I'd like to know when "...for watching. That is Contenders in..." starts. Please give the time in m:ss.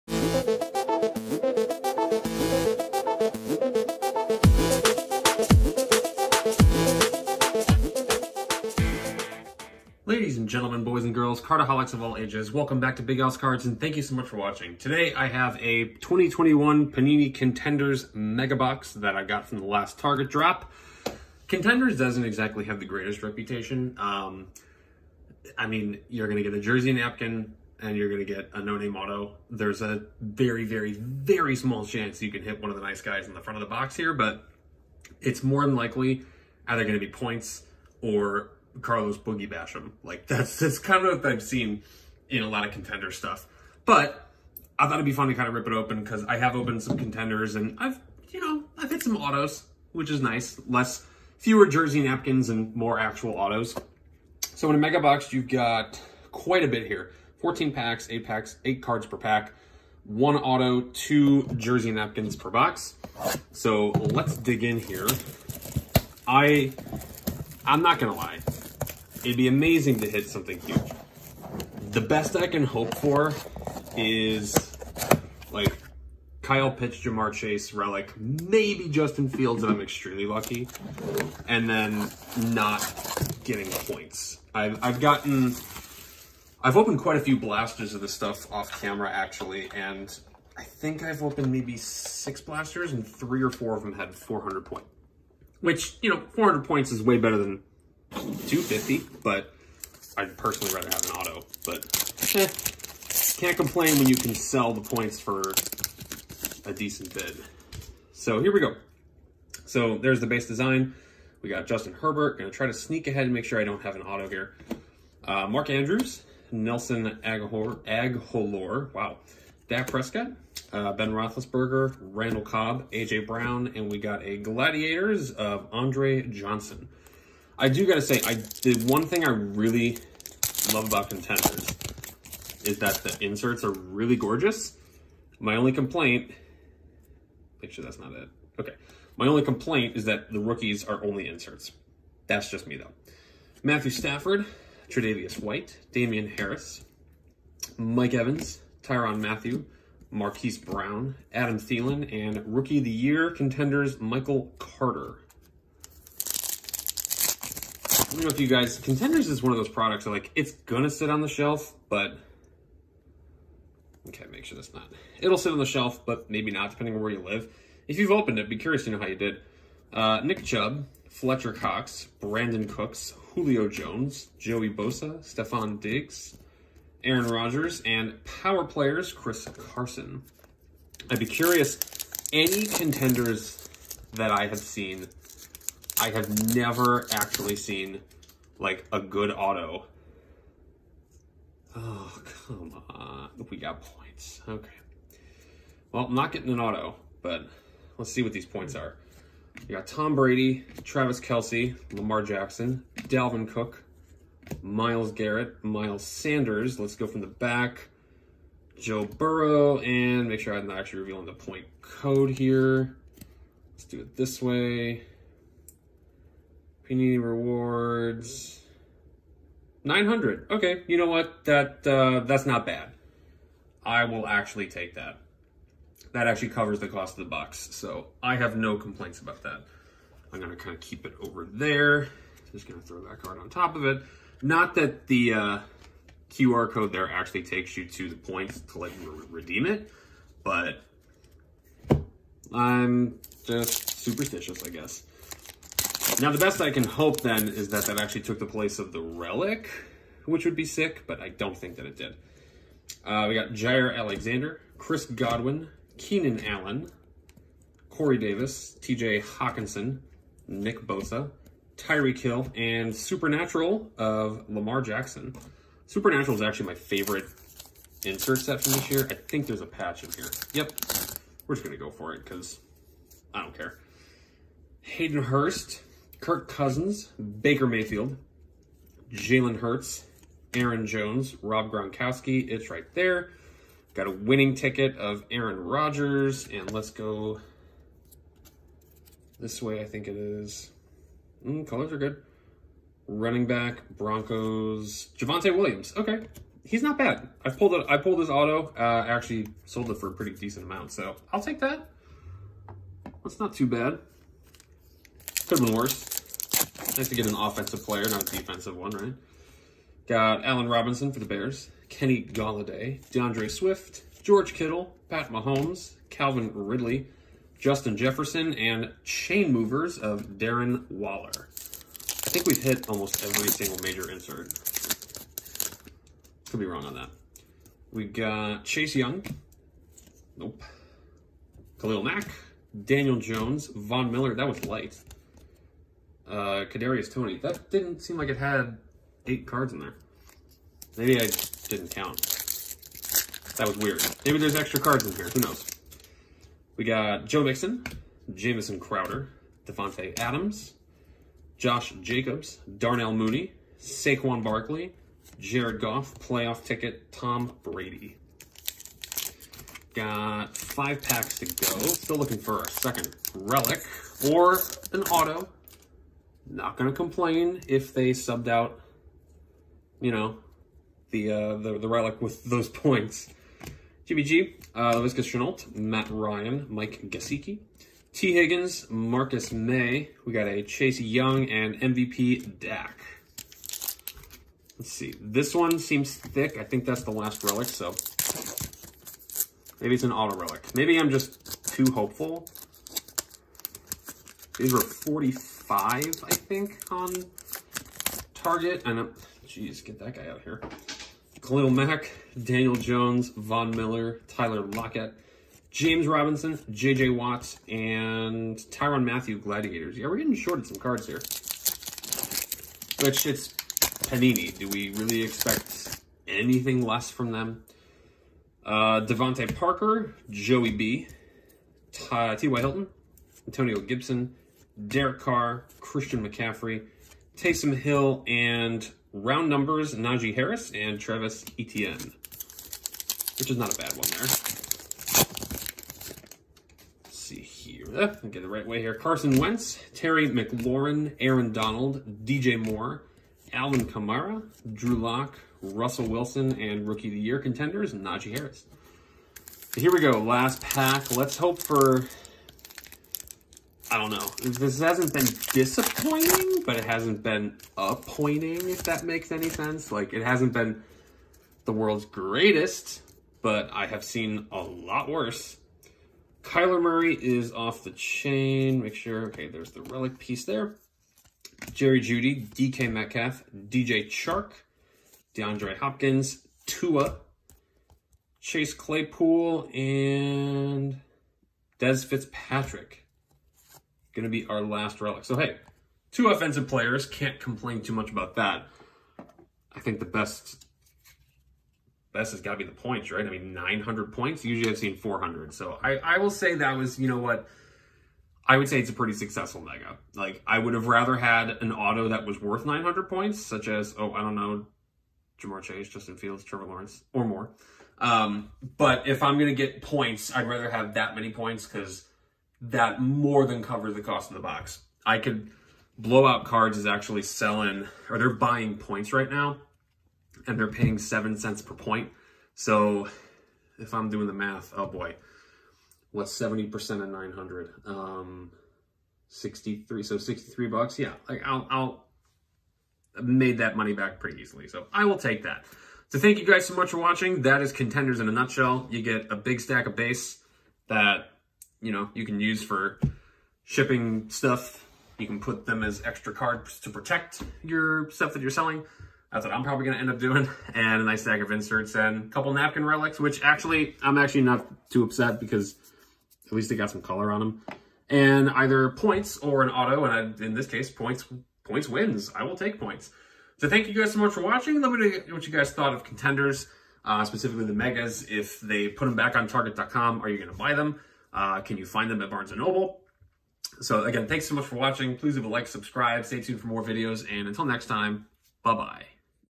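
8:56.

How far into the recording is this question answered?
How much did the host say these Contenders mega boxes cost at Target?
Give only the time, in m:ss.
6:34.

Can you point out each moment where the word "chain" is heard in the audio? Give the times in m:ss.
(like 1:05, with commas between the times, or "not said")
5:19, 7:47.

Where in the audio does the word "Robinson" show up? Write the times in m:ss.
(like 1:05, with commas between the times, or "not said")
5:10, 6:46.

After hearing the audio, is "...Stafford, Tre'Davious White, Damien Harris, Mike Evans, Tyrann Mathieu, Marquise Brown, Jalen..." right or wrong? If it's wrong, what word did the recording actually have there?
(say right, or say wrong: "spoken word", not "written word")
wrong: "Adam", not "Jalen".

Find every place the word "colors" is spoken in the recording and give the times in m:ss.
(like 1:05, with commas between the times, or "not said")
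4:51, 9:17.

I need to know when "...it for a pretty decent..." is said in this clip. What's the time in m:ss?
4:59.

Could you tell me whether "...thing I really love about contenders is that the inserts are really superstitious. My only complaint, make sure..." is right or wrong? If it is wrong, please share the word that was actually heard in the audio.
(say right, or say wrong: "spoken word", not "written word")
wrong: "gorgeous", not "superstitious".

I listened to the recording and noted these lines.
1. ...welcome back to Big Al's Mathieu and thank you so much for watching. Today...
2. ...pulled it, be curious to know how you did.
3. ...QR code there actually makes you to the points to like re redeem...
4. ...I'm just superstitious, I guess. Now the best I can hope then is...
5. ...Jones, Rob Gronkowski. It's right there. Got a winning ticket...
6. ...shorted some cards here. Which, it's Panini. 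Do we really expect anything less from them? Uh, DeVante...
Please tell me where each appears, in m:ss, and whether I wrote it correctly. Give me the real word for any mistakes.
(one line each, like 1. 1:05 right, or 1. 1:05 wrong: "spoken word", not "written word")
1. 0:12 wrong: "Cards", not "Mathieu"
2. 2:48 wrong: "opened", not "pulled"
3. 3:56 wrong: "takes", not "makes"
4. 4:02 right
5. 4:40 right
6. 6:50 right.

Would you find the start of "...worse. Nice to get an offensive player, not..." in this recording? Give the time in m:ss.
5:05.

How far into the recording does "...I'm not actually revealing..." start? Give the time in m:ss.
3:30.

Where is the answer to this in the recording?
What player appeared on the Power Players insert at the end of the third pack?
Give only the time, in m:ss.
2:59.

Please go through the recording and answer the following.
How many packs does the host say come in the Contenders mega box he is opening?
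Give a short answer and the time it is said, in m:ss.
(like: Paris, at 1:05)
14, at 0:57.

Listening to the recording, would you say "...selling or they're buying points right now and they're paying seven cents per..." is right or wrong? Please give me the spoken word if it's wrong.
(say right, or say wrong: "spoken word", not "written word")
right.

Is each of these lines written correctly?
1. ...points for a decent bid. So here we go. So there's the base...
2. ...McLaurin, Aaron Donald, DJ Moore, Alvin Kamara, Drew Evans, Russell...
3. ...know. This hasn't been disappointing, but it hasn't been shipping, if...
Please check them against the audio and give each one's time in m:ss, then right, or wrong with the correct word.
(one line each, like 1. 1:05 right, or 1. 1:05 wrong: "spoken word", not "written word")
1. 1:44 right
2. 7:20 wrong: "Lock", not "Evans"
3. 7:34 wrong: "appointing", not "shipping".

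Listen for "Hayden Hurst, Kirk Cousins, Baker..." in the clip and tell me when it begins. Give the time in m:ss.
4:34.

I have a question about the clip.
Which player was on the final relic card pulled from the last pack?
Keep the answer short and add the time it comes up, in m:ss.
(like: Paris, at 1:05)
Des Fitzpatrick, at 8:01.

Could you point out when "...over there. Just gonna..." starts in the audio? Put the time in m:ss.
3:51.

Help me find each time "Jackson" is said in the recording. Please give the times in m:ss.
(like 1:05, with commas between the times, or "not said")
3:22, 4:24.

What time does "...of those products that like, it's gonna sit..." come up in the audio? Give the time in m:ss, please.
2:39.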